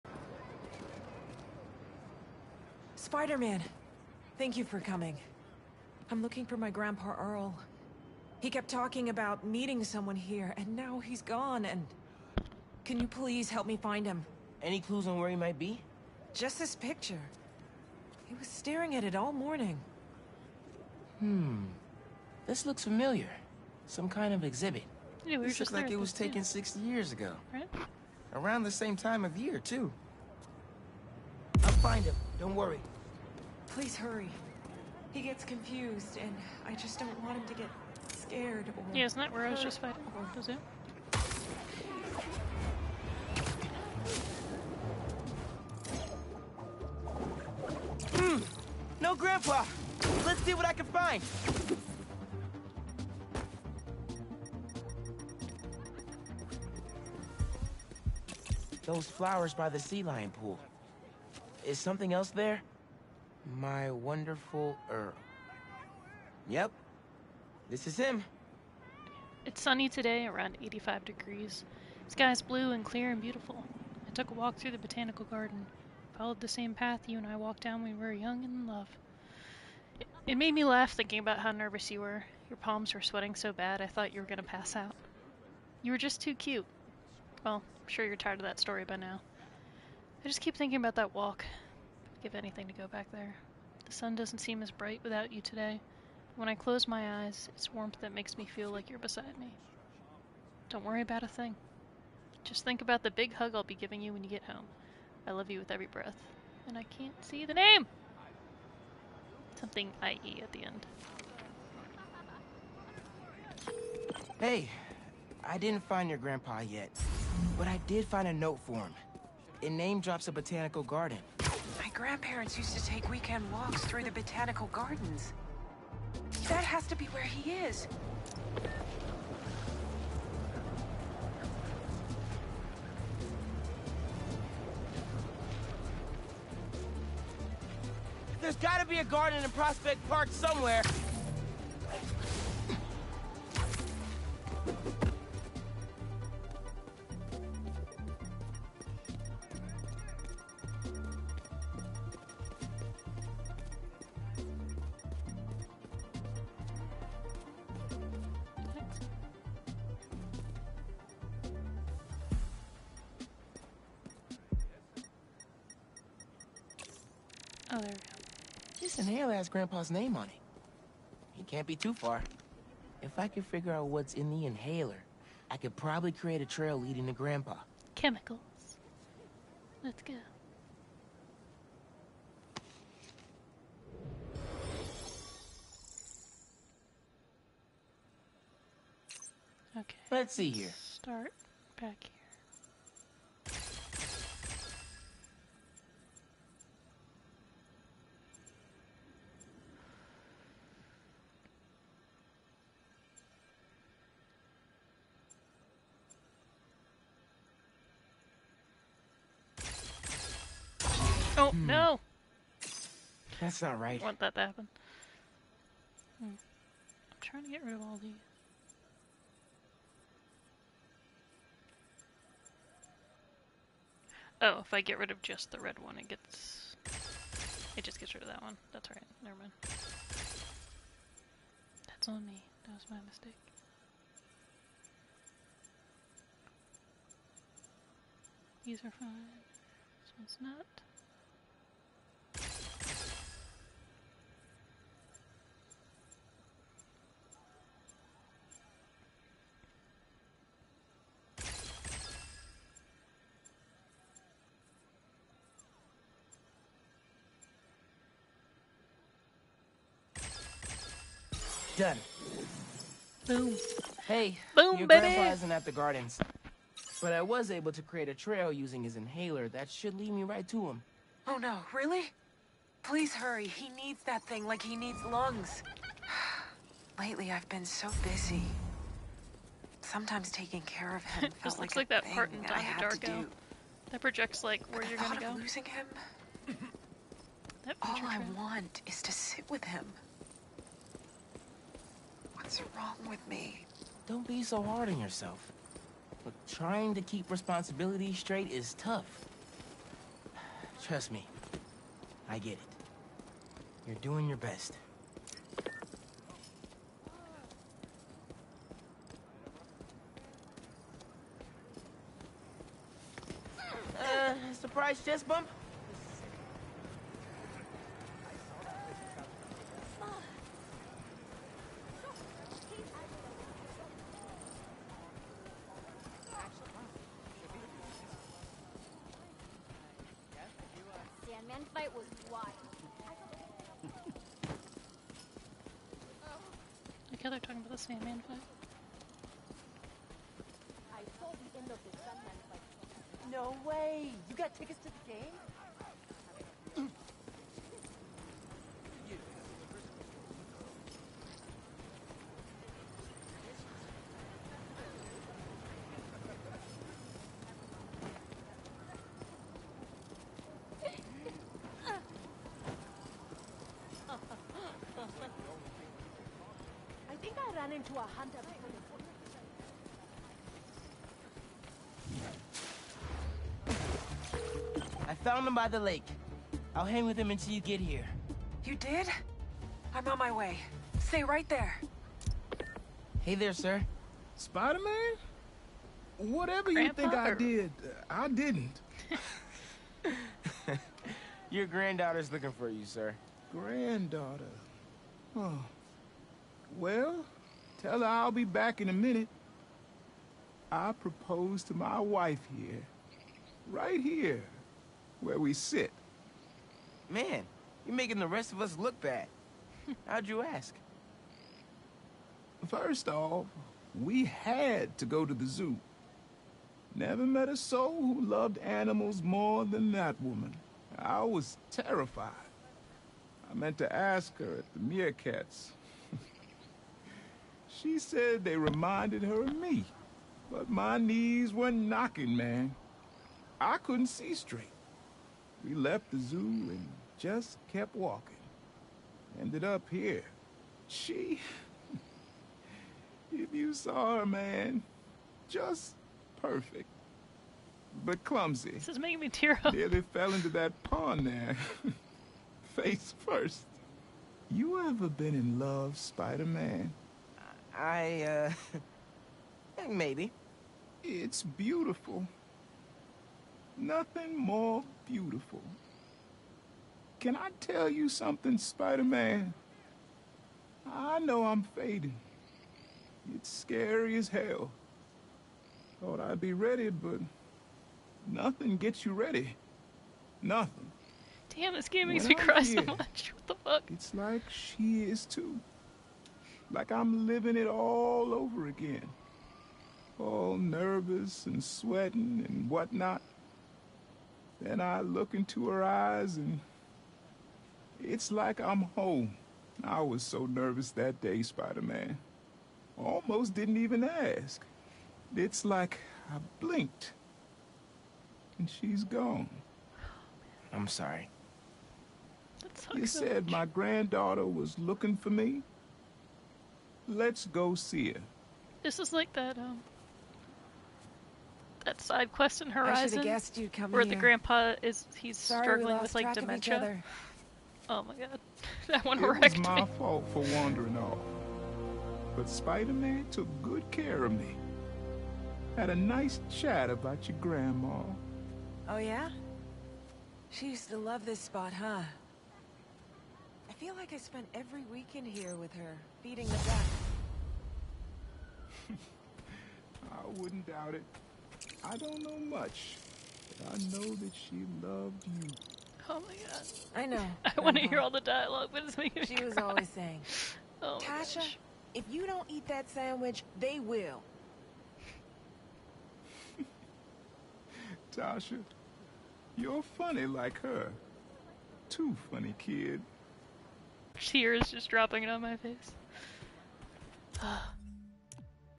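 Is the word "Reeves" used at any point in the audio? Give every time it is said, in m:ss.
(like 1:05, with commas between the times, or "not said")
not said.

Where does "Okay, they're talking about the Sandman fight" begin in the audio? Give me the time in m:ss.
5:37.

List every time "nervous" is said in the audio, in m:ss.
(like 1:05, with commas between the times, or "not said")
1:21, 8:10, 8:20.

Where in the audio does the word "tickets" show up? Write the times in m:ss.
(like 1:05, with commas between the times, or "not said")
5:44.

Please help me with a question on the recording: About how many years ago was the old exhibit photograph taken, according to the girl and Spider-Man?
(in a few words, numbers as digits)
60.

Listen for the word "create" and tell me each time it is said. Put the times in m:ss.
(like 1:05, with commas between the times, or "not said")
2:56, 4:27.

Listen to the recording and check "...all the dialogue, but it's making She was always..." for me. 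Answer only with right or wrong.
right.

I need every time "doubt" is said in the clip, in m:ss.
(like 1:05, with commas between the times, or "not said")
9:10.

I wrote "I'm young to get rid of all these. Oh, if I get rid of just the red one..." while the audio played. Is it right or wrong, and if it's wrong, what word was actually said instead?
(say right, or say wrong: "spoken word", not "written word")
wrong: "trying", not "young".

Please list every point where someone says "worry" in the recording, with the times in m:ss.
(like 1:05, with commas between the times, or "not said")
0:32, 1:40.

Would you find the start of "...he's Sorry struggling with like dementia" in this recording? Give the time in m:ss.
8:45.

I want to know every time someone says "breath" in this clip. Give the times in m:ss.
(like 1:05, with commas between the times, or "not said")
1:45.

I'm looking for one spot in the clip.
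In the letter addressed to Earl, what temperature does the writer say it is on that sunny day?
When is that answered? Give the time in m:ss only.
1:10.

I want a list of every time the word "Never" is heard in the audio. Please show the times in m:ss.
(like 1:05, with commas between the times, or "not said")
3:49, 6:56.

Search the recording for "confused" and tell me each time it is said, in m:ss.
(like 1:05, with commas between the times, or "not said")
0:35.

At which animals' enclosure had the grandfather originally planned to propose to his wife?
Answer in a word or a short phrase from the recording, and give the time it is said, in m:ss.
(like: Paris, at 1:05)
Meerkats, at 7:04.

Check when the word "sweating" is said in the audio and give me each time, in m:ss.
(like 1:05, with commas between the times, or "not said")
1:23, 8:11.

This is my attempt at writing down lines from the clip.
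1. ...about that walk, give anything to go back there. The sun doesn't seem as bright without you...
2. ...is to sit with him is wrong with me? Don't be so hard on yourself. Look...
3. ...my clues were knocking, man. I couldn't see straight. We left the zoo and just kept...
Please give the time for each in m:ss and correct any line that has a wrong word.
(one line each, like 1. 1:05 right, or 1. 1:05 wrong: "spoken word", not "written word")
1. 1:30 right
2. 4:48 right
3. 7:10 wrong: "knees", not "clues".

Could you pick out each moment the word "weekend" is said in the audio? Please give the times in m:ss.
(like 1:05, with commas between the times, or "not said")
2:03, 9:04.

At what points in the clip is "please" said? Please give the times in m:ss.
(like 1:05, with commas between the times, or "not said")
0:13, 0:33, 4:32.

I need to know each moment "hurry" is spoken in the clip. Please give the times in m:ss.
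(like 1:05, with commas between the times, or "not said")
0:33, 4:33.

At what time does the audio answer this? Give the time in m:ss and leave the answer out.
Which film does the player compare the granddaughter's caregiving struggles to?
4:42.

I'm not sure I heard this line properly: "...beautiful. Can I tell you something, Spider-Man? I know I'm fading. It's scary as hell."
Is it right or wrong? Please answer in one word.
right.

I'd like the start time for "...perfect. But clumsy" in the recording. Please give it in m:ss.
7:26.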